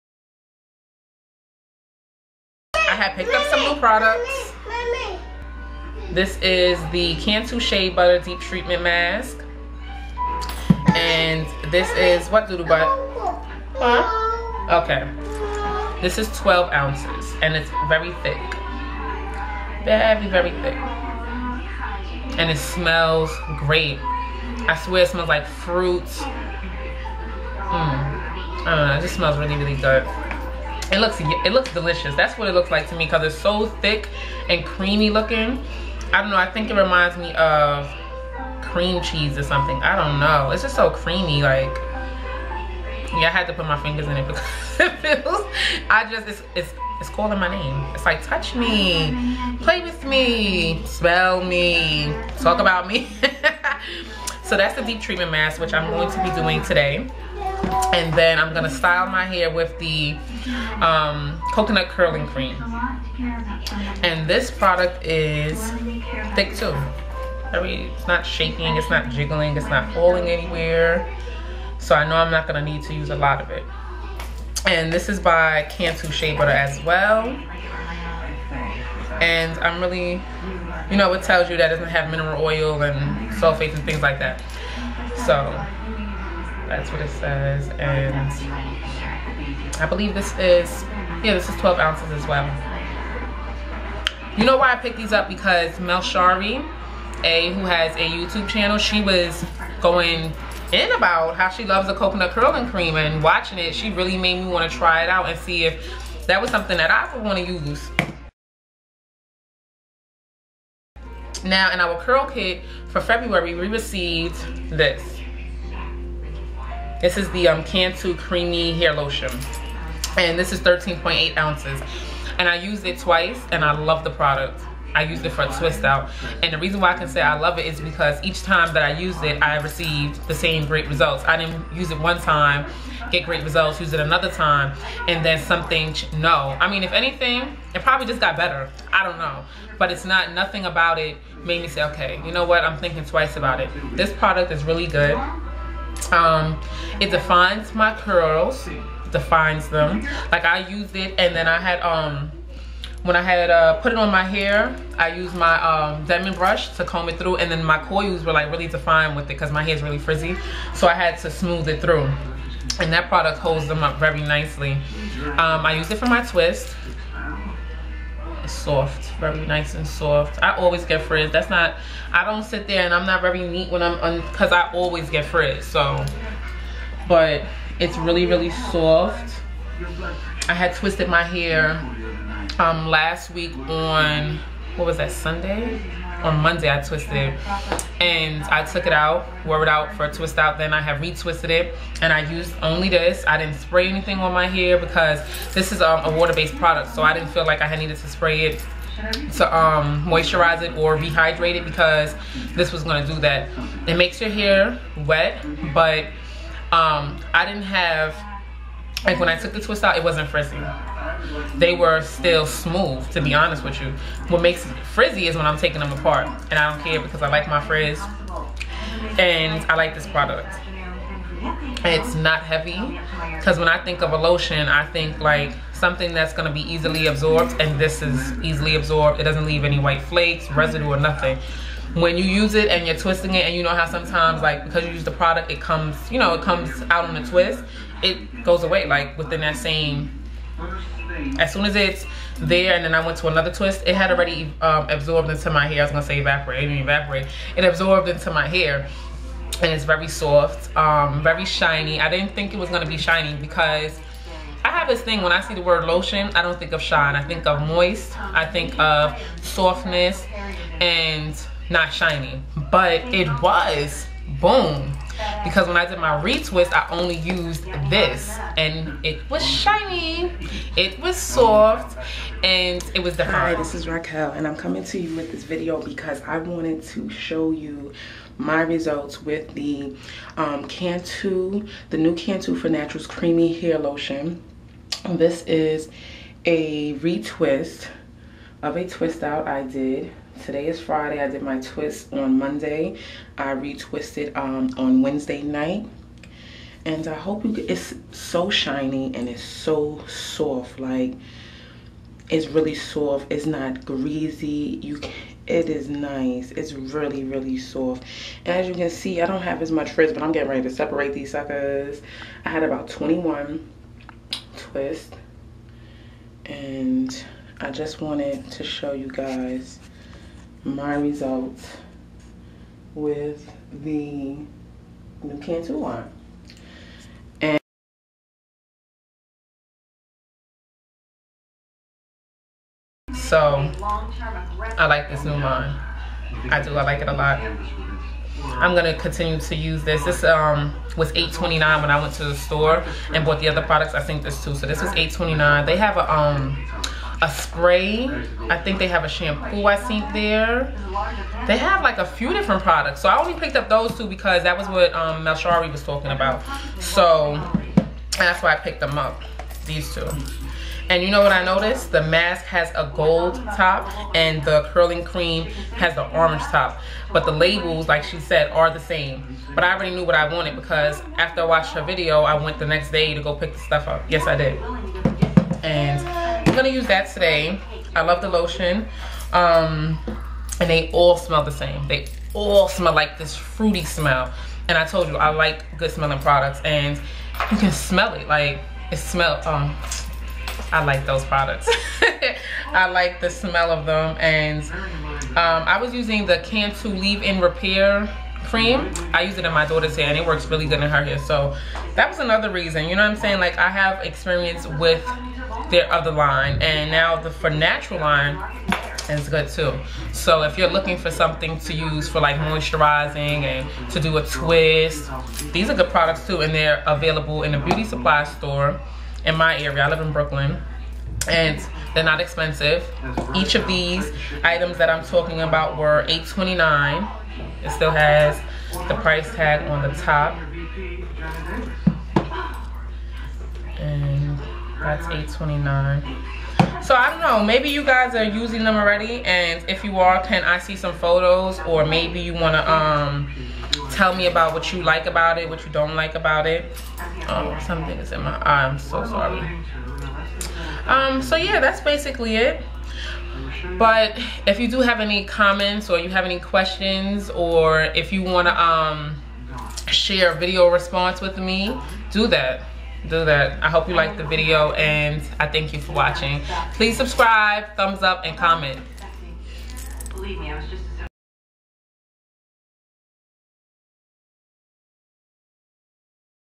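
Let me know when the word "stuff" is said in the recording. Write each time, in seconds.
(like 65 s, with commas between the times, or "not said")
373 s.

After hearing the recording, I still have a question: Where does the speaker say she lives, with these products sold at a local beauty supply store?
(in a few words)
Brooklyn.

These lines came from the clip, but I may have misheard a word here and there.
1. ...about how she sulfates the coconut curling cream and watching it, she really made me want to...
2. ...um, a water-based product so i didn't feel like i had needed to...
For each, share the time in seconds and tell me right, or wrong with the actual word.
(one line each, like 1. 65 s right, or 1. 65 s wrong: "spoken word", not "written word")
1. 100 s wrong: "loves", not "sulfates"
2. 195 s right.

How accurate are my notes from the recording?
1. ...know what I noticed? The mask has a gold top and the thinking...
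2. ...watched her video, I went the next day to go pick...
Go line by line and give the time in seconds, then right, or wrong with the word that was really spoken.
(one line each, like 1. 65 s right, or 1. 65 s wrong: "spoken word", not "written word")
1. 361 s wrong: "curling", not "thinking"
2. 371 s right.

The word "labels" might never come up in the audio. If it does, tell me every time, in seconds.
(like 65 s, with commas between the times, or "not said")
367 s.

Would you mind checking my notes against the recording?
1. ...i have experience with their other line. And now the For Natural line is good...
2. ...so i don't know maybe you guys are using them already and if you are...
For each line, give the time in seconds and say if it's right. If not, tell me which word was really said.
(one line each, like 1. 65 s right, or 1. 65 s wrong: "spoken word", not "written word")
1. 403 s right
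2. 436 s right.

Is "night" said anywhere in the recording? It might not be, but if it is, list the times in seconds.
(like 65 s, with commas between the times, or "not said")
295 s.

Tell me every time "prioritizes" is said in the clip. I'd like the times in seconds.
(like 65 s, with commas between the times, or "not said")
not said.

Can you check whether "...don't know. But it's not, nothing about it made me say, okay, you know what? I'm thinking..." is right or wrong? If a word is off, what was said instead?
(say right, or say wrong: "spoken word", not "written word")
right.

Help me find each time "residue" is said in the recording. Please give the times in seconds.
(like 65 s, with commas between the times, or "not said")
230 s.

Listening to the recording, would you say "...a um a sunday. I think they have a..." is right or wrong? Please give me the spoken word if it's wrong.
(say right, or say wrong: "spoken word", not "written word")
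wrong: "spray", not "sunday".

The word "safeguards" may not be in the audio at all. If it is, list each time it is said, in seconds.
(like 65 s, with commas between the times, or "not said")
not said.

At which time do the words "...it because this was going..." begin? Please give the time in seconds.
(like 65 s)
201 s.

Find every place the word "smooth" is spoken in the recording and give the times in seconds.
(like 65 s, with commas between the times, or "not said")
161 s, 212 s.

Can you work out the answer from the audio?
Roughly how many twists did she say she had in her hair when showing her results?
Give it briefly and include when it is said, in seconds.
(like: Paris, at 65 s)
21, at 312 s.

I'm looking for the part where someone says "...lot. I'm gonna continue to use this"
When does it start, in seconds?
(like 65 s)
337 s.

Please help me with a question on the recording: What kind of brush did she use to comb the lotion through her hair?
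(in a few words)
diamond brush.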